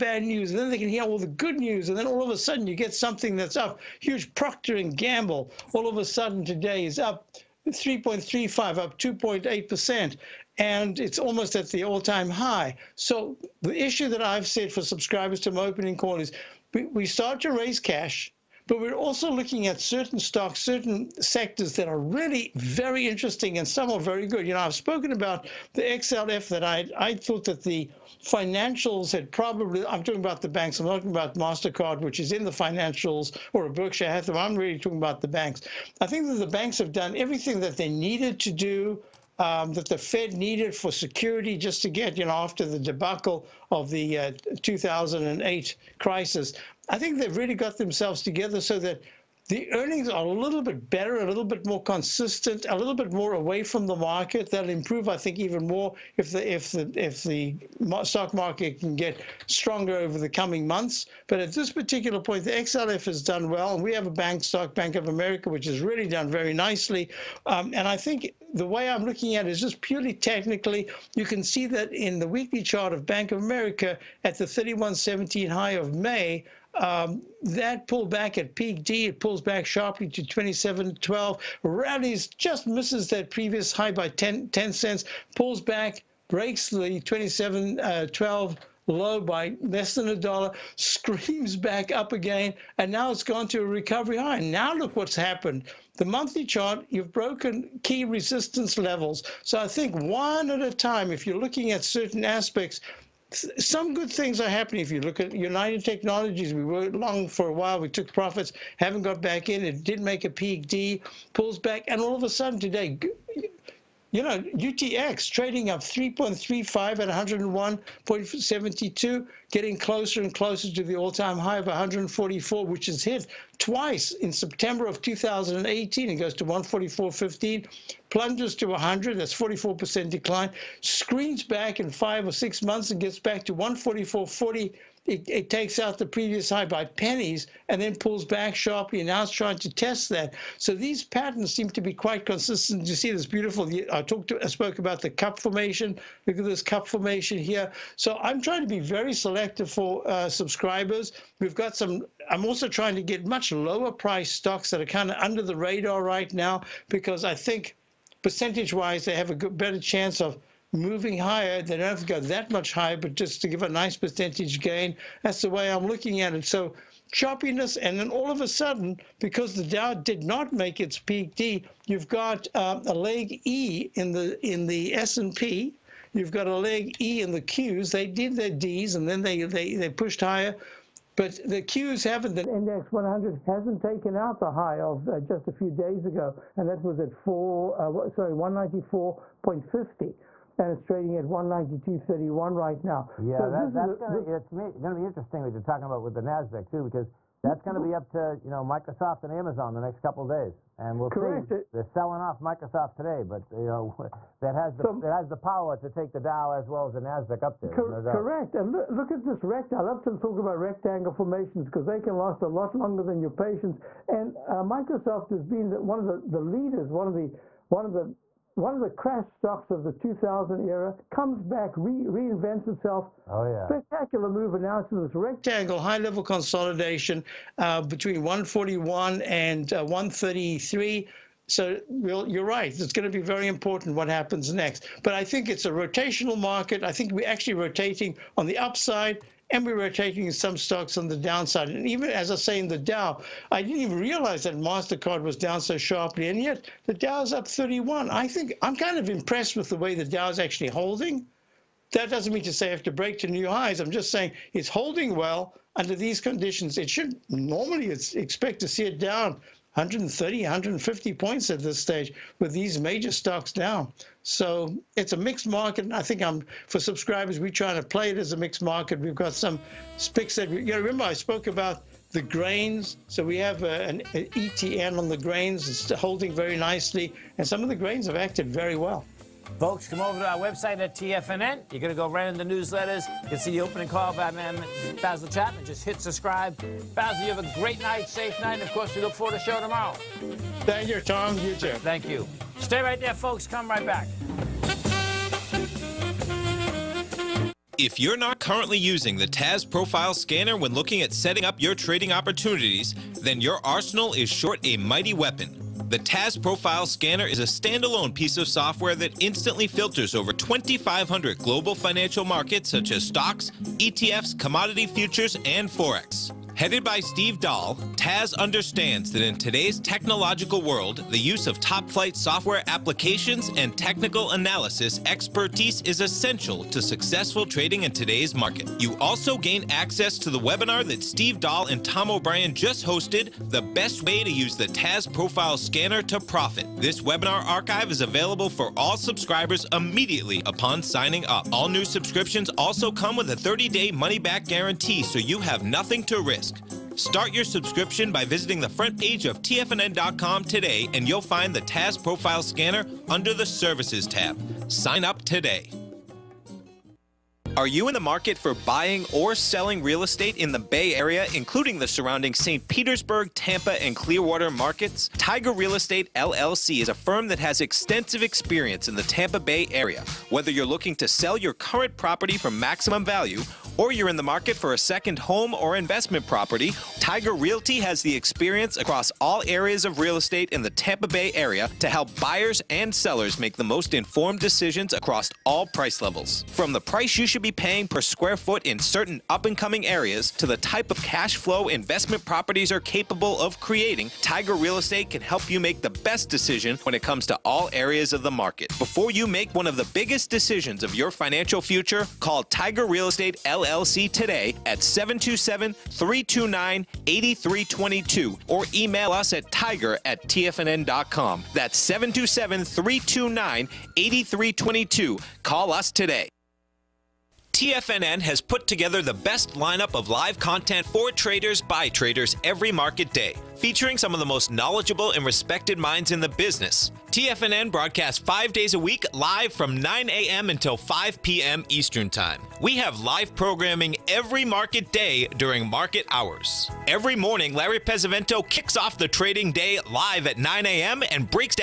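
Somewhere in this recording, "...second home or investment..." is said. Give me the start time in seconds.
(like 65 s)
374 s.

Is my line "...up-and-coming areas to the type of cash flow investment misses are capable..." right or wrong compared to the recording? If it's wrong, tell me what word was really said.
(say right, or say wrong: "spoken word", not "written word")
wrong: "properties", not "misses".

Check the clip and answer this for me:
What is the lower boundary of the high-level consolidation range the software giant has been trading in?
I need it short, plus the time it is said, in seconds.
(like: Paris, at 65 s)
133, at 229 s.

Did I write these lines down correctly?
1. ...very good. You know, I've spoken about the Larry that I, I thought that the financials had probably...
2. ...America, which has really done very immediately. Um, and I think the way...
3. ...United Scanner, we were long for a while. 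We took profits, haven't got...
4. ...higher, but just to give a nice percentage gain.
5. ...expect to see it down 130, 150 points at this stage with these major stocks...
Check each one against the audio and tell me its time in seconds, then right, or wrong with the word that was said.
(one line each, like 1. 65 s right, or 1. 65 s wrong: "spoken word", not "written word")
1. 23 s wrong: "XLF", not "Larry"
2. 65 s wrong: "nicely", not "immediately"
3. 105 s wrong: "Technologies", not "Scanner"
4. 162 s right
5. 258 s right.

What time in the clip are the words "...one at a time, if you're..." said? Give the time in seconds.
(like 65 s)
99 s.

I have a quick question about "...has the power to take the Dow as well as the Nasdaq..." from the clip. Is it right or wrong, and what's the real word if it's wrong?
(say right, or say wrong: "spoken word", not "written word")
right.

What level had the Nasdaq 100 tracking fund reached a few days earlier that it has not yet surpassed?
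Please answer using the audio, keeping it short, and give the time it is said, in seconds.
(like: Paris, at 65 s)
194.50, at 188 s.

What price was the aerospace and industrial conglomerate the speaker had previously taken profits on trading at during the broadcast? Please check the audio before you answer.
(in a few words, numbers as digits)
101.72.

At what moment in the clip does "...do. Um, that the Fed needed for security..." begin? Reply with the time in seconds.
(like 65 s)
38 s.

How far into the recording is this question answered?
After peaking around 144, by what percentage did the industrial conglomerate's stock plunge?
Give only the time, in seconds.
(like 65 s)
129 s.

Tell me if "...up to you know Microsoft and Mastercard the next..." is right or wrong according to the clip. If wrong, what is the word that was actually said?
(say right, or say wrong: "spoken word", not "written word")
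wrong: "Amazon", not "Mastercard".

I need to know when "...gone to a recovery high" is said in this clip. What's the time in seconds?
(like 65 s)
93 s.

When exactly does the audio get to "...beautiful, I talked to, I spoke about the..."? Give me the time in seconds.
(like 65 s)
143 s.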